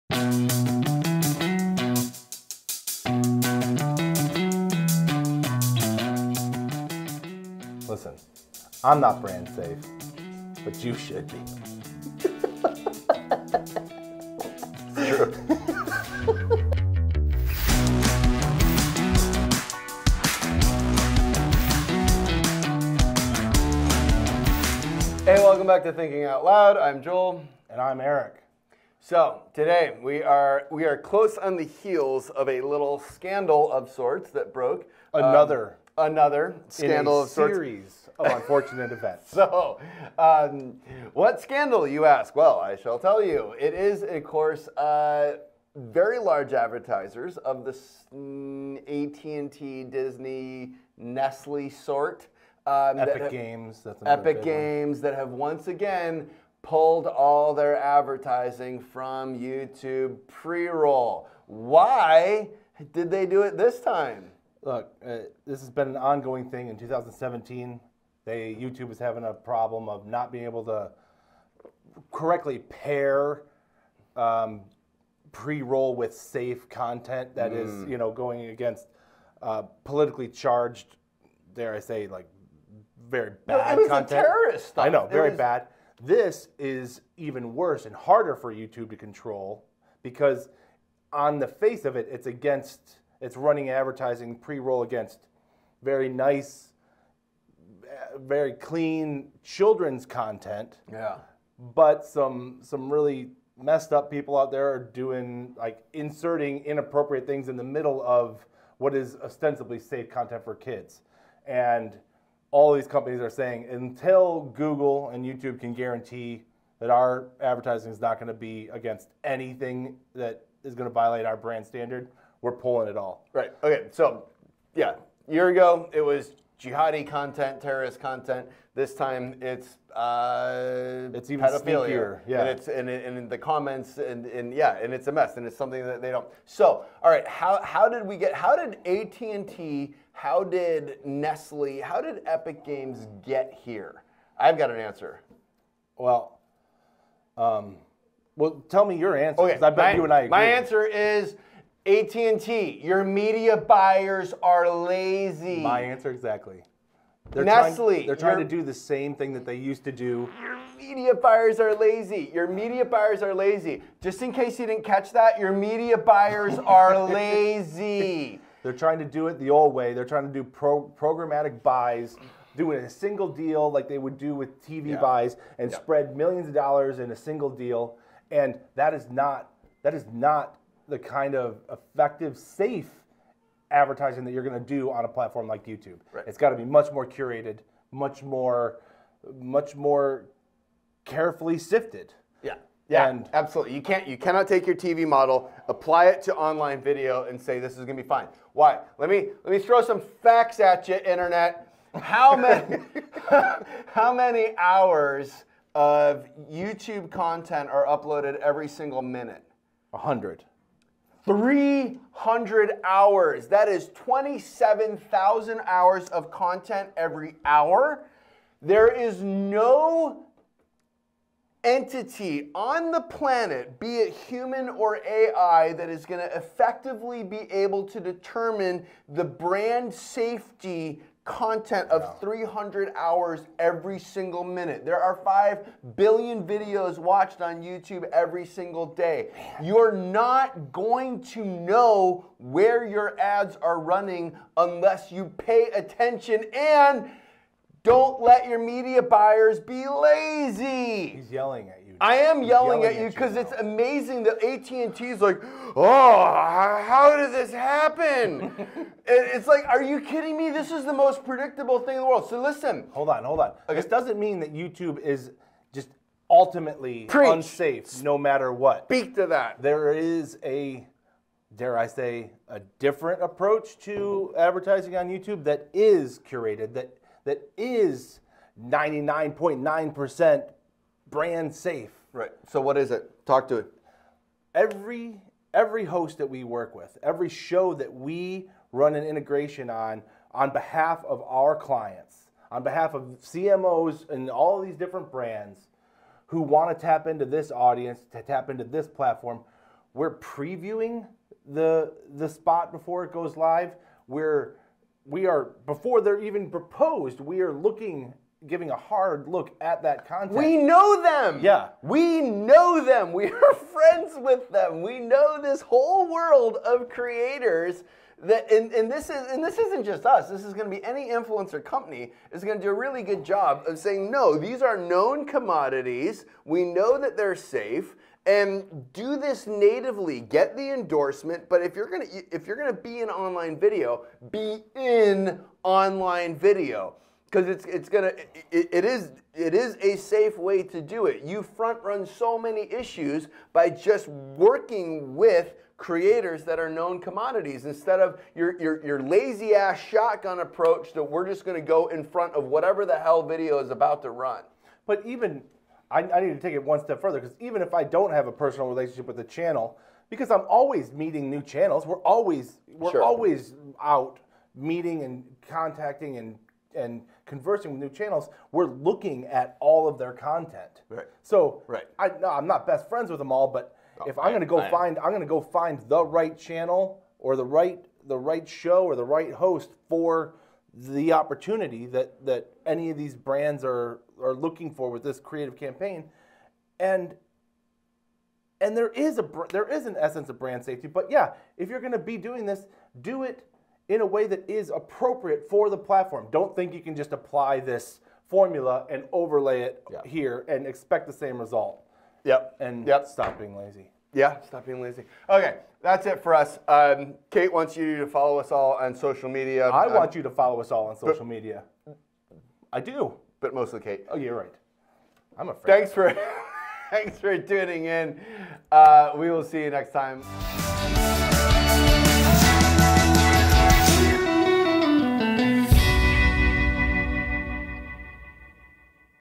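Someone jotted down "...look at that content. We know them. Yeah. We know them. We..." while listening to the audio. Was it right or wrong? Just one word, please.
right.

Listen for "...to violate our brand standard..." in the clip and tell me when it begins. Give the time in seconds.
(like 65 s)
120 s.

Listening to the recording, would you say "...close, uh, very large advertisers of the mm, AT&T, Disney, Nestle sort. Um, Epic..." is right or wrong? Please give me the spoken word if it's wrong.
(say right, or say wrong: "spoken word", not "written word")
wrong: "course", not "close".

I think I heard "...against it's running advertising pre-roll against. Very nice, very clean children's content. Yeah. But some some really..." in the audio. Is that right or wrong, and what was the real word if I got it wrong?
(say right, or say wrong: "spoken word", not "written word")
right.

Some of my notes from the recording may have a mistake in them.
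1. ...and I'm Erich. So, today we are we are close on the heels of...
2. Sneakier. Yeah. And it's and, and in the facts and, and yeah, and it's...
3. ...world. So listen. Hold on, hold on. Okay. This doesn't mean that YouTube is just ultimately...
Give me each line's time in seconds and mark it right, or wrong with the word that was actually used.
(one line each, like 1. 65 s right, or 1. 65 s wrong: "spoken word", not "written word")
1. 27 s right
2. 131 s wrong: "comments", not "facts"
3. 262 s right.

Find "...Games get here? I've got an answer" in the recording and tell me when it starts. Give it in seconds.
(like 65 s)
142 s.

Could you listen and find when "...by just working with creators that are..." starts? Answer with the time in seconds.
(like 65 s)
343 s.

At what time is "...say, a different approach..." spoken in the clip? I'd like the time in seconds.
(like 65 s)
271 s.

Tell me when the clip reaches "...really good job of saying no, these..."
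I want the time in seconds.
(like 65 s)
322 s.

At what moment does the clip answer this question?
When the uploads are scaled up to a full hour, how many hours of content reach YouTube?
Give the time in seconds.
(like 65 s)
213 s.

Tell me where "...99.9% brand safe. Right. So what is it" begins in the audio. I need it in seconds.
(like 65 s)
278 s.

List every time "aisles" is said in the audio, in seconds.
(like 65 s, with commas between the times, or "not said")
not said.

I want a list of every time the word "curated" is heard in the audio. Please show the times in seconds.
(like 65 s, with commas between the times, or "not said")
187 s, 276 s.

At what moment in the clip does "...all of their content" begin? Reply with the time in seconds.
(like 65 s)
369 s.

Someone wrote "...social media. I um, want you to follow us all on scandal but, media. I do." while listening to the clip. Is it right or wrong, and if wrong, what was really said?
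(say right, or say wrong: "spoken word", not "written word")
wrong: "social", not "scandal".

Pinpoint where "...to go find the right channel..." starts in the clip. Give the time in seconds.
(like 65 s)
375 s.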